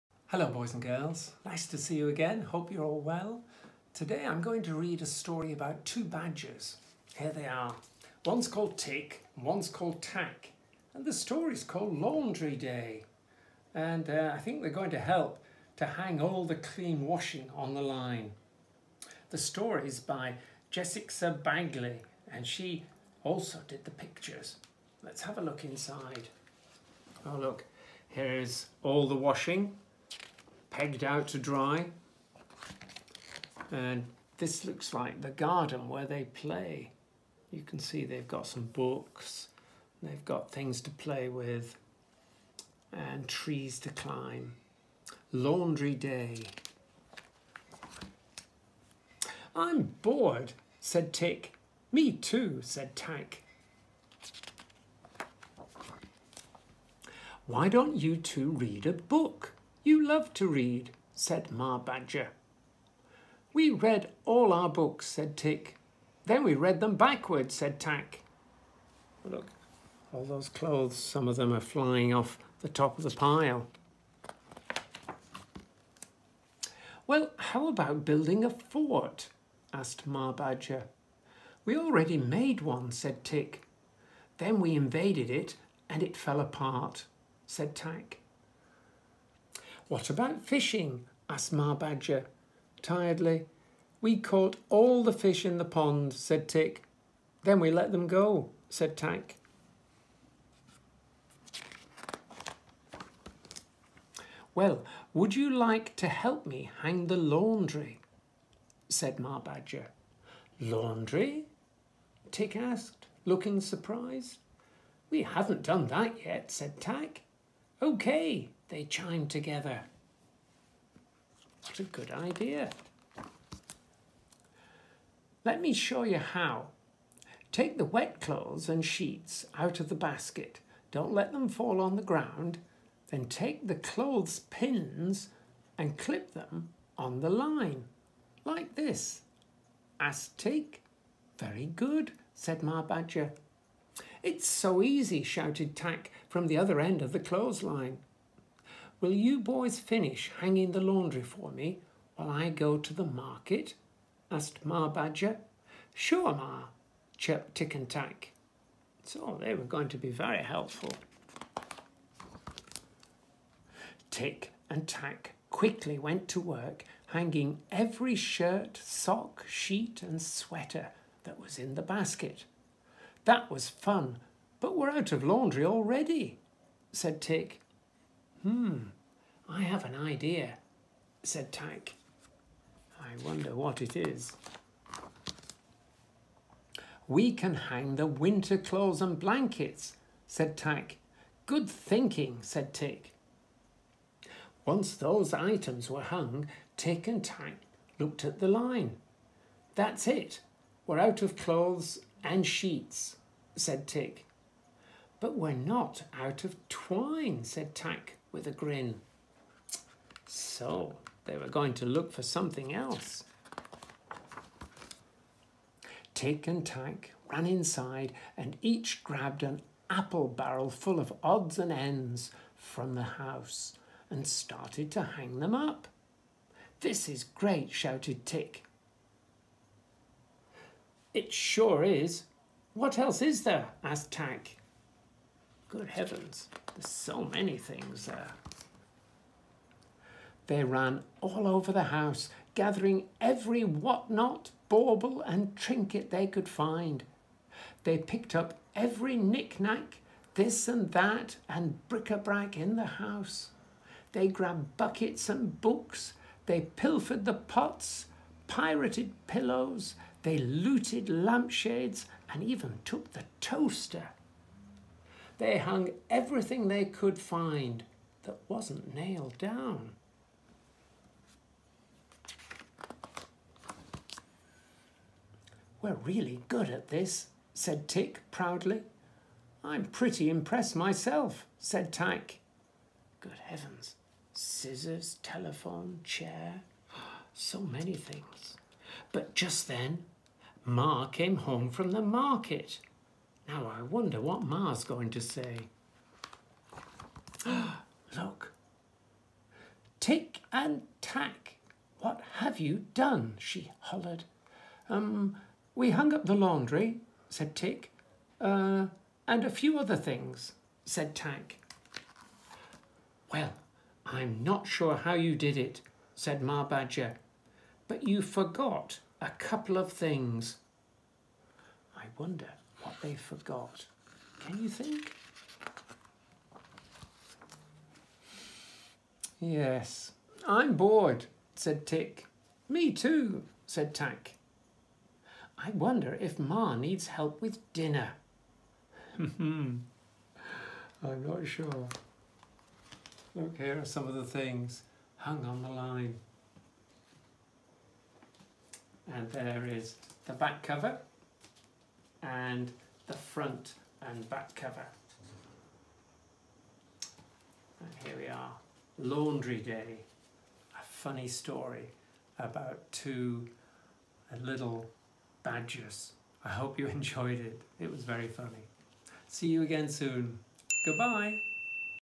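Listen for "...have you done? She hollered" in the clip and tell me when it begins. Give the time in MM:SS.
05:02.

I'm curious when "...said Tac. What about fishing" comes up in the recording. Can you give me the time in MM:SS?
01:27.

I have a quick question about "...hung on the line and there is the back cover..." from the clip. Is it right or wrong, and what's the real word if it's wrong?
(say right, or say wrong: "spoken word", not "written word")
right.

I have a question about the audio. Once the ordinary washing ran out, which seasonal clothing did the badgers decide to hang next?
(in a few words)
winter clothes.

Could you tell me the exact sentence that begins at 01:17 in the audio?
Well, how about building a fort?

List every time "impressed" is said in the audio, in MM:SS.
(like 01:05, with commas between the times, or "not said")
04:40.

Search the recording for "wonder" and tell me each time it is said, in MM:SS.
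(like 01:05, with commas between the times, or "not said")
03:03, 04:53, 05:22, 05:35.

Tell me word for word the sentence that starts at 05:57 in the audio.
And here we are, Laundry Day, a funny story about two little badgers.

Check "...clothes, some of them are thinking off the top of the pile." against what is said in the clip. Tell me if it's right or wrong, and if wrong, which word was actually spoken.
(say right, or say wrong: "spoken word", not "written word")
wrong: "flying", not "thinking".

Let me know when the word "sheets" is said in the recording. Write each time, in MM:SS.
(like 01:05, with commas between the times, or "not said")
02:08, 02:49, 03:22.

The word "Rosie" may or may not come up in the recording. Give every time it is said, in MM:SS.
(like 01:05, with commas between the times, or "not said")
not said.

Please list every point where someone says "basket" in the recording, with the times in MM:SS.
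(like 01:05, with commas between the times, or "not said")
02:09, 02:51.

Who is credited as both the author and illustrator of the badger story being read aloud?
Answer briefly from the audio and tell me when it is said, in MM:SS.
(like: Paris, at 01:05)
Jessica Bagley, at 00:20.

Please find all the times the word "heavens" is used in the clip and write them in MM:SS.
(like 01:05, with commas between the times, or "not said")
03:55, 04:43.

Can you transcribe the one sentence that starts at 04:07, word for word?
They picked up every knick-knack, this and that, and bric-a-brac in the house.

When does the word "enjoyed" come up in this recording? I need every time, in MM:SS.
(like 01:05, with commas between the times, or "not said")
06:06.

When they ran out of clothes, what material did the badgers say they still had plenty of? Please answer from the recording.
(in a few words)
twine.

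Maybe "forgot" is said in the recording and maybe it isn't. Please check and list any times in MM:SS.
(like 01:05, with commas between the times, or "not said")
05:18, 05:23.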